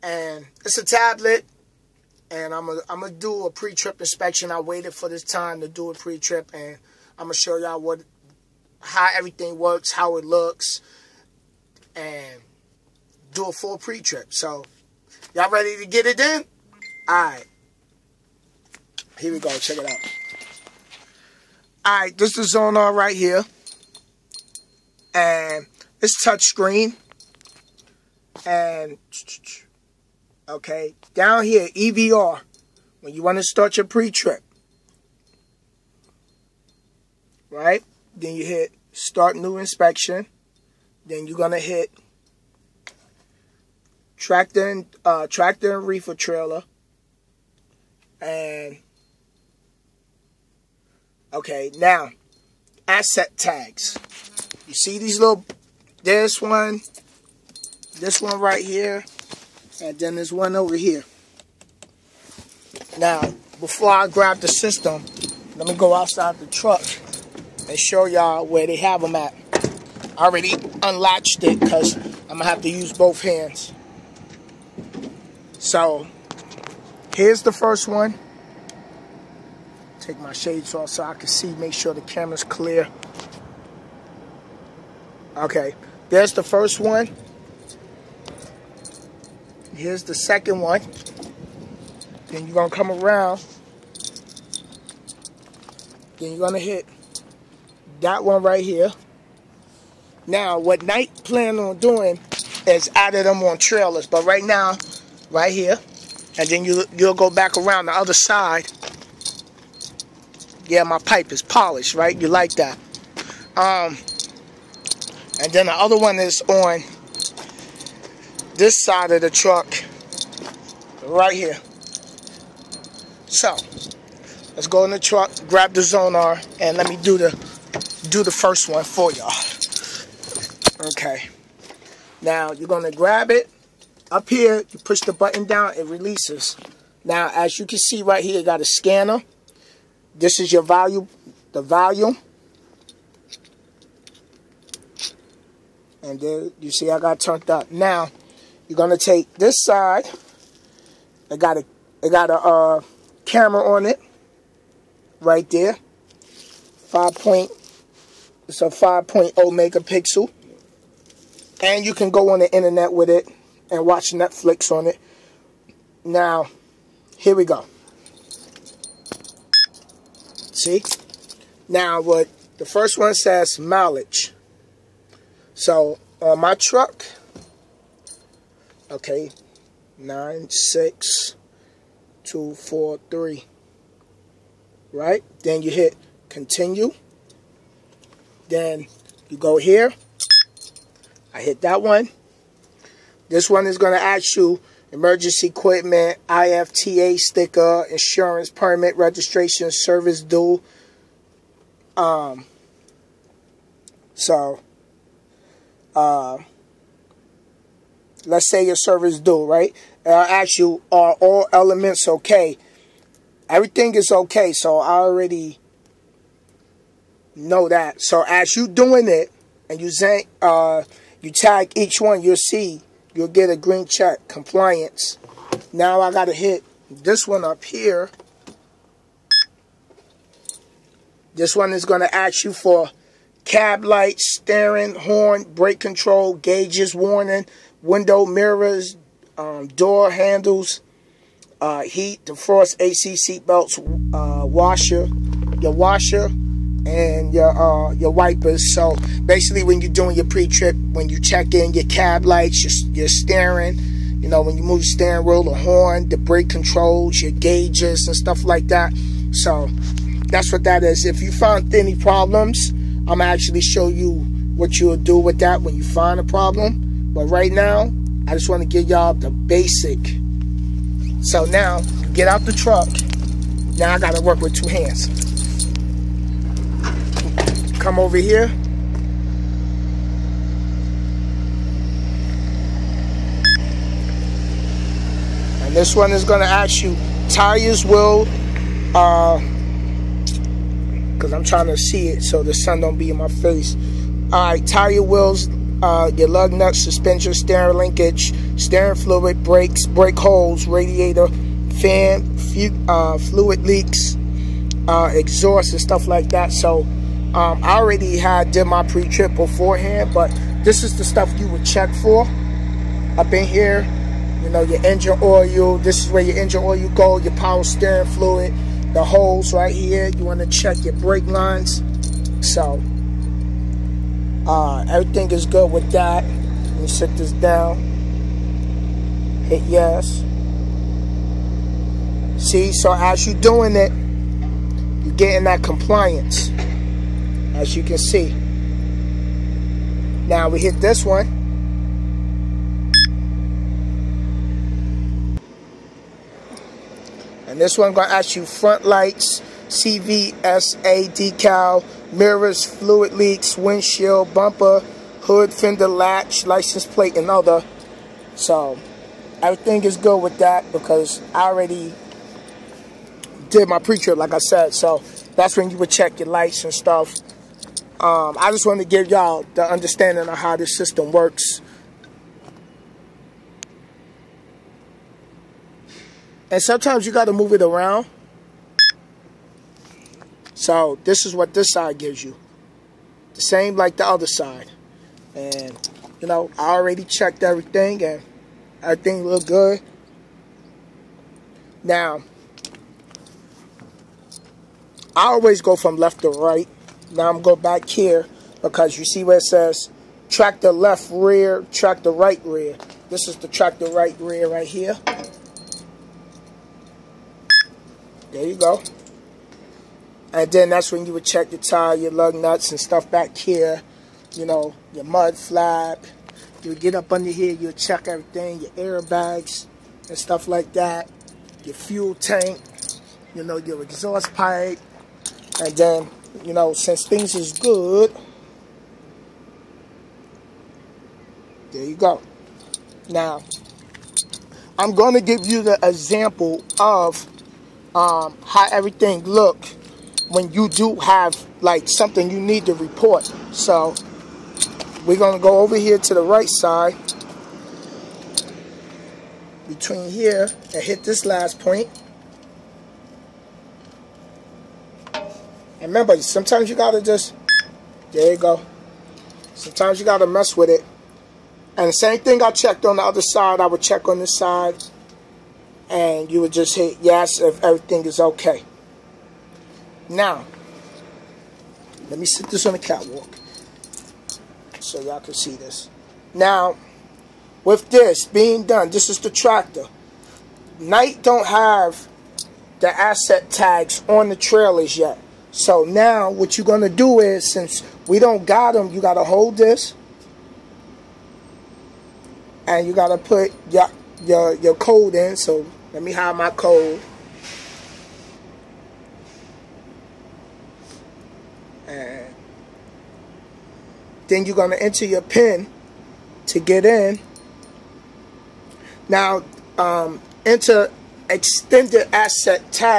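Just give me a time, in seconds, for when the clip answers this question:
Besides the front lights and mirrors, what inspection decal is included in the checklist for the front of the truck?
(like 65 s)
349 s.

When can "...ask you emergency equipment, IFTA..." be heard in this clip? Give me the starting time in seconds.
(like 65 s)
194 s.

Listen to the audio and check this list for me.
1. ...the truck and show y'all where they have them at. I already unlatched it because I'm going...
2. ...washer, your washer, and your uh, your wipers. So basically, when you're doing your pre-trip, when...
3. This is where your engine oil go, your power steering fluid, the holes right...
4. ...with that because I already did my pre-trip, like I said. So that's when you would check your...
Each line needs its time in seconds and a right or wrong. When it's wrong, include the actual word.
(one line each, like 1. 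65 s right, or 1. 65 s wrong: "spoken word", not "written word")
1. 66 s right
2. 244 s right
3. 315 s right
4. 360 s right.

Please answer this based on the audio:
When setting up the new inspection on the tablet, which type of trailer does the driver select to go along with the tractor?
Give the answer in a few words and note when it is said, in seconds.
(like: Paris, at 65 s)
reefer trailer, at 45 s.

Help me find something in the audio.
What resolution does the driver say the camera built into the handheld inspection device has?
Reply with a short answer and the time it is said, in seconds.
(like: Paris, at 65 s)
5.0 megapixel, at 158 s.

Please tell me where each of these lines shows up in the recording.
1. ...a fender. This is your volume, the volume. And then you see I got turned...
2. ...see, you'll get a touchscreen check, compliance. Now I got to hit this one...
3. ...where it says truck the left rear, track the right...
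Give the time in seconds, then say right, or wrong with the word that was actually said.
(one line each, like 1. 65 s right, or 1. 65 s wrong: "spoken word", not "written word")
1. 138 s wrong: "scanner", not "fender"
2. 222 s wrong: "green", not "touchscreen"
3. 399 s wrong: "track", not "truck".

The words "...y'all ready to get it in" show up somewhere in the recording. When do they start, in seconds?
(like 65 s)
15 s.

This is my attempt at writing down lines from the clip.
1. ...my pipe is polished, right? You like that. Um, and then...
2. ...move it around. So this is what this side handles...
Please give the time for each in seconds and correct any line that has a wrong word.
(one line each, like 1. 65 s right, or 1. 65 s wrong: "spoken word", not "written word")
1. 110 s right
2. 377 s wrong: "gives", not "handles".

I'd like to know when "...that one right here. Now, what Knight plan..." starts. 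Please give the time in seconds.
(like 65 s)
98 s.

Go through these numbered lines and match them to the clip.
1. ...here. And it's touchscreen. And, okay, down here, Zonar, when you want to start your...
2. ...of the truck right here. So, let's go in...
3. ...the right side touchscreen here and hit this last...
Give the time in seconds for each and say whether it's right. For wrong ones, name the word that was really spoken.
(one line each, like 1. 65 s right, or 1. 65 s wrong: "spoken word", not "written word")
1. 23 s wrong: "EVR", not "Zonar"
2. 119 s right
3. 446 s wrong: "between", not "touchscreen".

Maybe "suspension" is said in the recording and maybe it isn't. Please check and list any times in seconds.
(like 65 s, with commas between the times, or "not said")
296 s.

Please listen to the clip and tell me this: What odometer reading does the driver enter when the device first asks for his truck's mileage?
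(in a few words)
96243.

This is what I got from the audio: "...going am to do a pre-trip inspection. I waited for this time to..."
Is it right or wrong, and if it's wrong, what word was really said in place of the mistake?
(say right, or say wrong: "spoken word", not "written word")
right.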